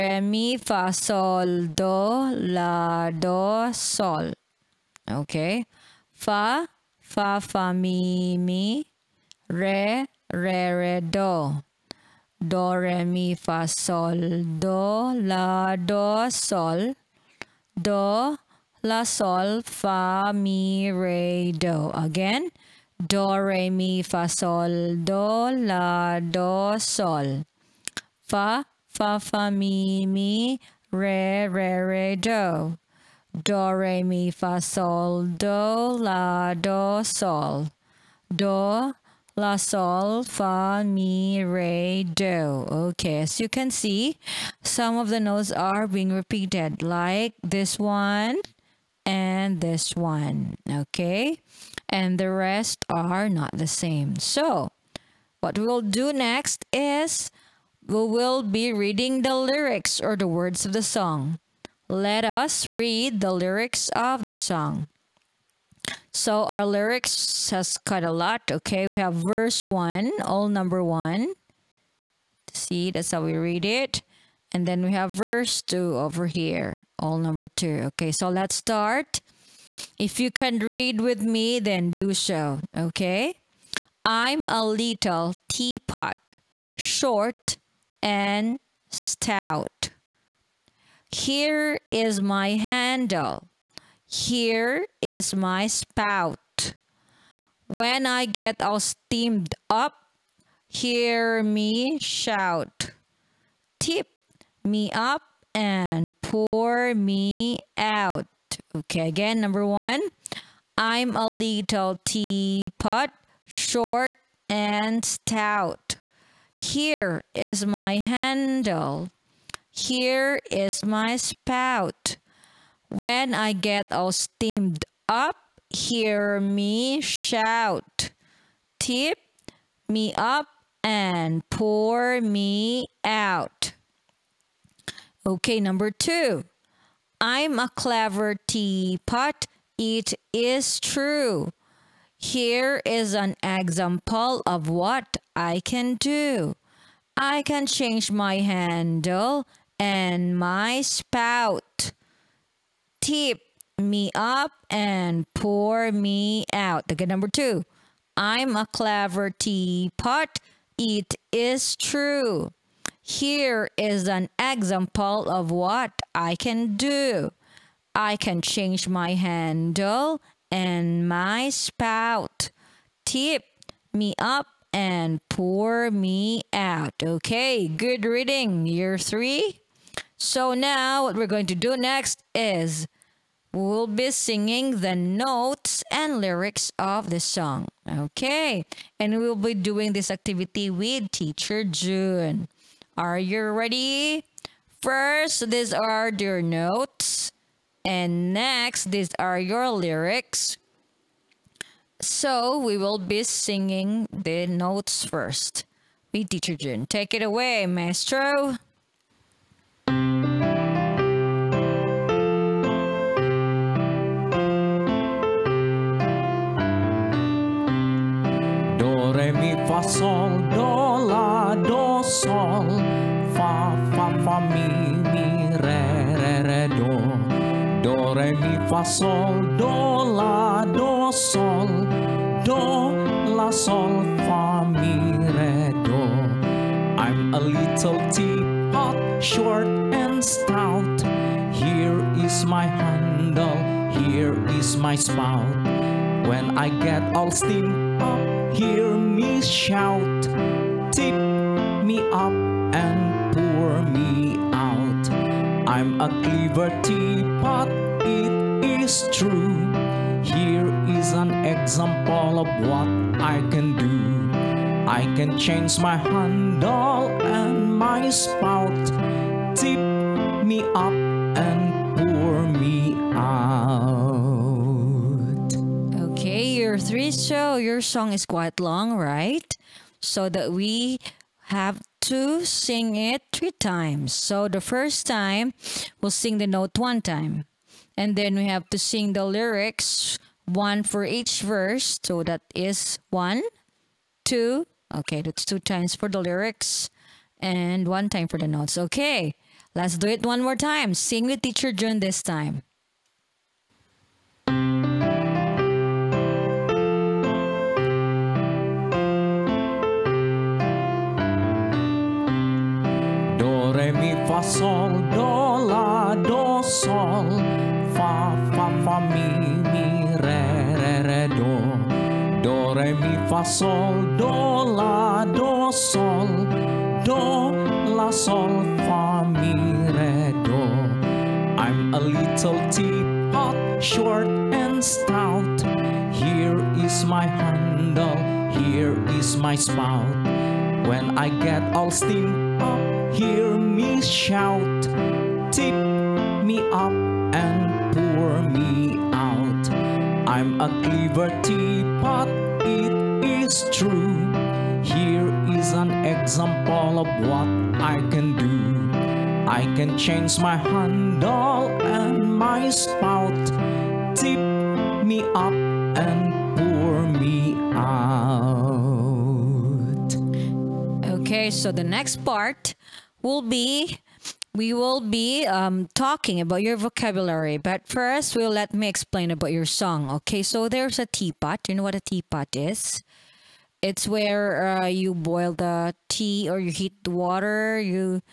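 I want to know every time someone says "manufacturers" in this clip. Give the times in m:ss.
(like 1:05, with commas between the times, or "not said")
not said.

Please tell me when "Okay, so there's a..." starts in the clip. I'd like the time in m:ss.
6:20.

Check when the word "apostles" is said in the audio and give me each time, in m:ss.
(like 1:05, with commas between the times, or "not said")
not said.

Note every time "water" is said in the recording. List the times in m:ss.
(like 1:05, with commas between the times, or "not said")
6:27.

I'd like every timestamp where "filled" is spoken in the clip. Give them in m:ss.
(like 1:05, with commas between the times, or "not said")
not said.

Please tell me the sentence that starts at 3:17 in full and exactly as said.
And next, these are your lyrics.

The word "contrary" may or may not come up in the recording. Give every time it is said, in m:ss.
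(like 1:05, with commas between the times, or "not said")
not said.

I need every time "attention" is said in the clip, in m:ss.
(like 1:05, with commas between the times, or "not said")
not said.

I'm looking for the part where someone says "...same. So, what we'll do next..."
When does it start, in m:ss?
0:53.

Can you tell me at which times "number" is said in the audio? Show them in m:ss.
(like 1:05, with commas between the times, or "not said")
1:10, 1:17, 1:49, 2:15, 2:37.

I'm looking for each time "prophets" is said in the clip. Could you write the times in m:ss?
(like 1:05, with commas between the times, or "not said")
not said.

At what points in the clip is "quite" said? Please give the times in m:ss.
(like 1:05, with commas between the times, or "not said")
1:07, 4:38.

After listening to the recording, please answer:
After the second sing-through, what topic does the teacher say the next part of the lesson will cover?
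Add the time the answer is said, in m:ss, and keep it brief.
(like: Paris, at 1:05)
vocabulary, at 6:16.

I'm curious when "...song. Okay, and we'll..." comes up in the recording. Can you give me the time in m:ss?
3:07.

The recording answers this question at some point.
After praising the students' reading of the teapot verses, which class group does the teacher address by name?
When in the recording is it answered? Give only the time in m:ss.
2:58.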